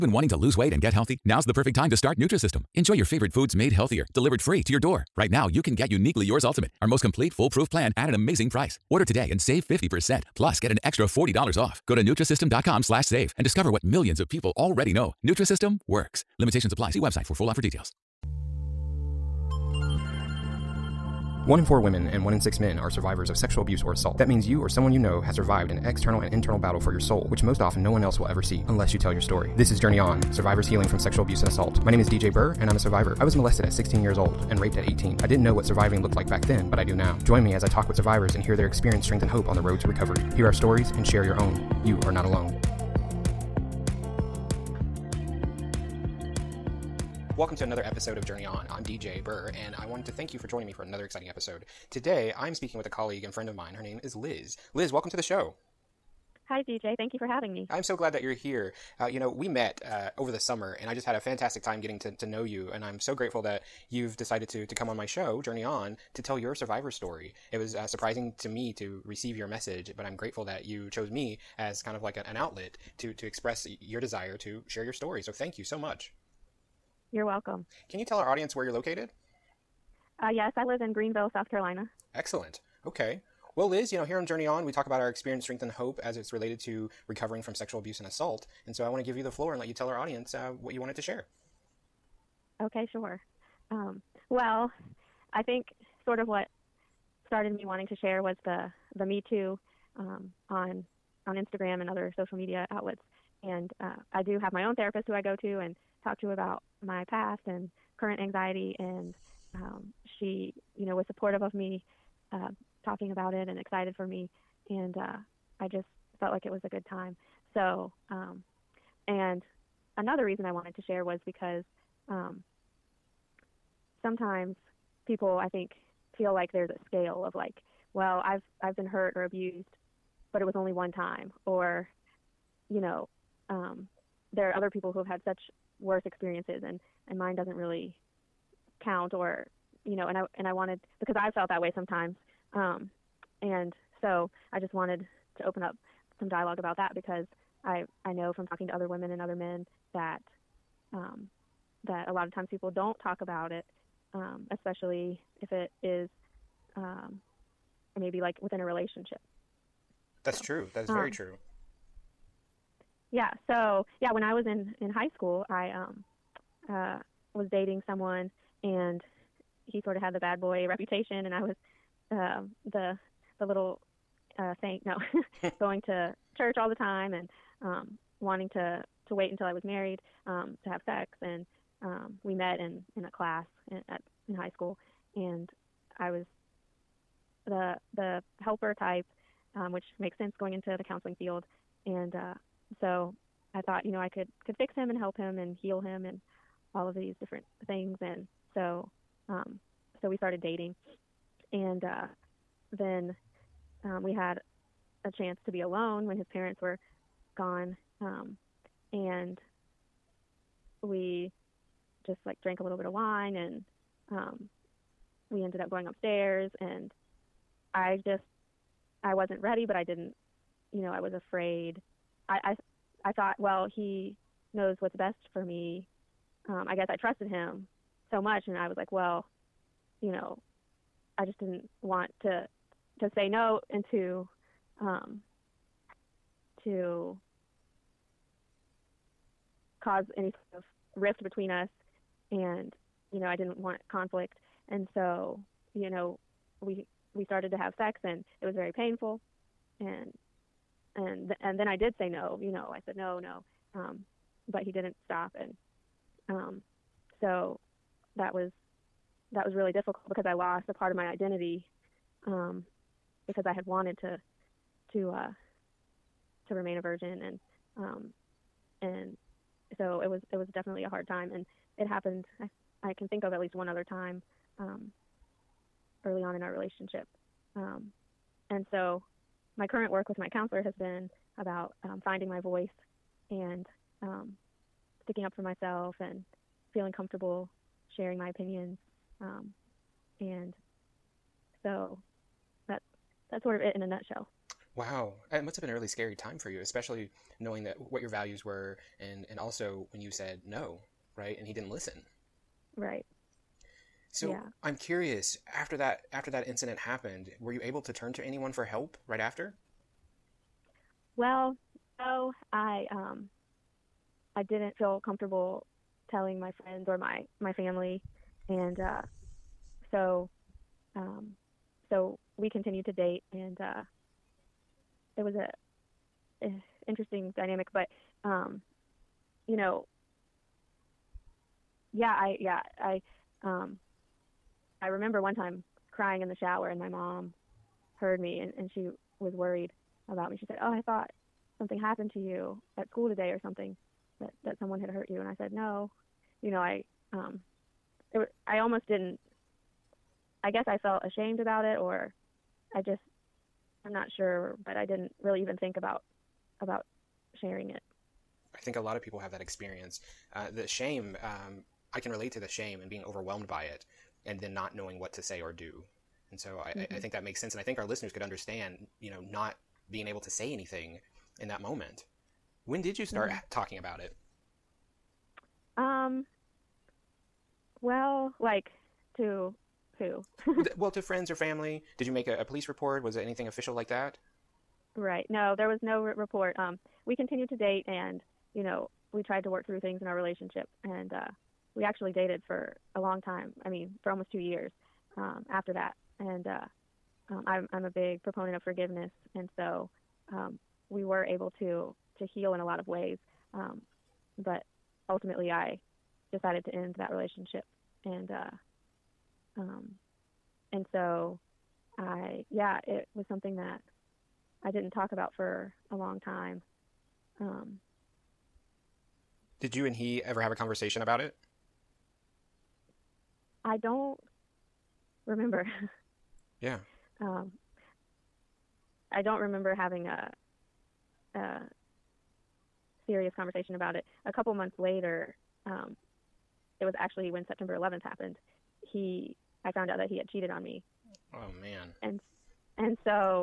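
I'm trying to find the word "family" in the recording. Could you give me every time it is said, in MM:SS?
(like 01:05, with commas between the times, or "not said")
05:17, 06:21.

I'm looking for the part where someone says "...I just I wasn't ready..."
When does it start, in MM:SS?
03:37.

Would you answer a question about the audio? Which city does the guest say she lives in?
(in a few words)
Greenville.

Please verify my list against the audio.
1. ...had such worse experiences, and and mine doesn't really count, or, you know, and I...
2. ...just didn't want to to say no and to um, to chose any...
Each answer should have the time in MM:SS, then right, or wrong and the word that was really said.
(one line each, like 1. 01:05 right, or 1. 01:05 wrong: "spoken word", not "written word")
1. 02:15 right
2. 03:51 wrong: "cause", not "chose".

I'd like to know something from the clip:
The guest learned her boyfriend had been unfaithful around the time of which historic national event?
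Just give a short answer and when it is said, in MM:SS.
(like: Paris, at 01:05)
September 11th, at 07:17.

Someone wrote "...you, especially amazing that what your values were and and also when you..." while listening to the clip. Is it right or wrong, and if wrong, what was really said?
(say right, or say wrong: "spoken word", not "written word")
wrong: "knowing", not "amazing".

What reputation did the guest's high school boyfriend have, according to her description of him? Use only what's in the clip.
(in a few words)
bad boy.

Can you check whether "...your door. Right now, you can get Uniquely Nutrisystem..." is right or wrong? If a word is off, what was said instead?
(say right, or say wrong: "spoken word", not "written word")
wrong: "Yours", not "Nutrisystem".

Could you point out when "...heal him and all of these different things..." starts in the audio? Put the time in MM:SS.
03:15.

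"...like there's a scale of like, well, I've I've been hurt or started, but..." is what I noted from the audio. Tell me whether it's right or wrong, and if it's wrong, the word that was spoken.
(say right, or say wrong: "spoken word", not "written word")
wrong: "abused", not "started".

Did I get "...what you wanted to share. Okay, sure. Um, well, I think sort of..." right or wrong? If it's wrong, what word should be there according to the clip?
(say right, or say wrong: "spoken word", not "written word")
right.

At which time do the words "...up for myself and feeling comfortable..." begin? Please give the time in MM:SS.
04:45.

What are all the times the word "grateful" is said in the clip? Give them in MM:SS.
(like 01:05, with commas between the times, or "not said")
01:03, 01:10.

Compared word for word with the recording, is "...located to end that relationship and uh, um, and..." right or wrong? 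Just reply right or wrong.
wrong.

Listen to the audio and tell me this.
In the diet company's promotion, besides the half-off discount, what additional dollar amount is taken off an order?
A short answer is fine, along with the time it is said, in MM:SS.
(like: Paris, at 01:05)
$40, at 00:11.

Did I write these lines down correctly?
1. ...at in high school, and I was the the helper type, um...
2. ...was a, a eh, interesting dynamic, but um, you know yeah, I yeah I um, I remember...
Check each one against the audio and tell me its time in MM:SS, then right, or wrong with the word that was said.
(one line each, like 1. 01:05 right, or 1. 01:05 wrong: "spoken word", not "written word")
1. 03:03 right
2. 05:25 right.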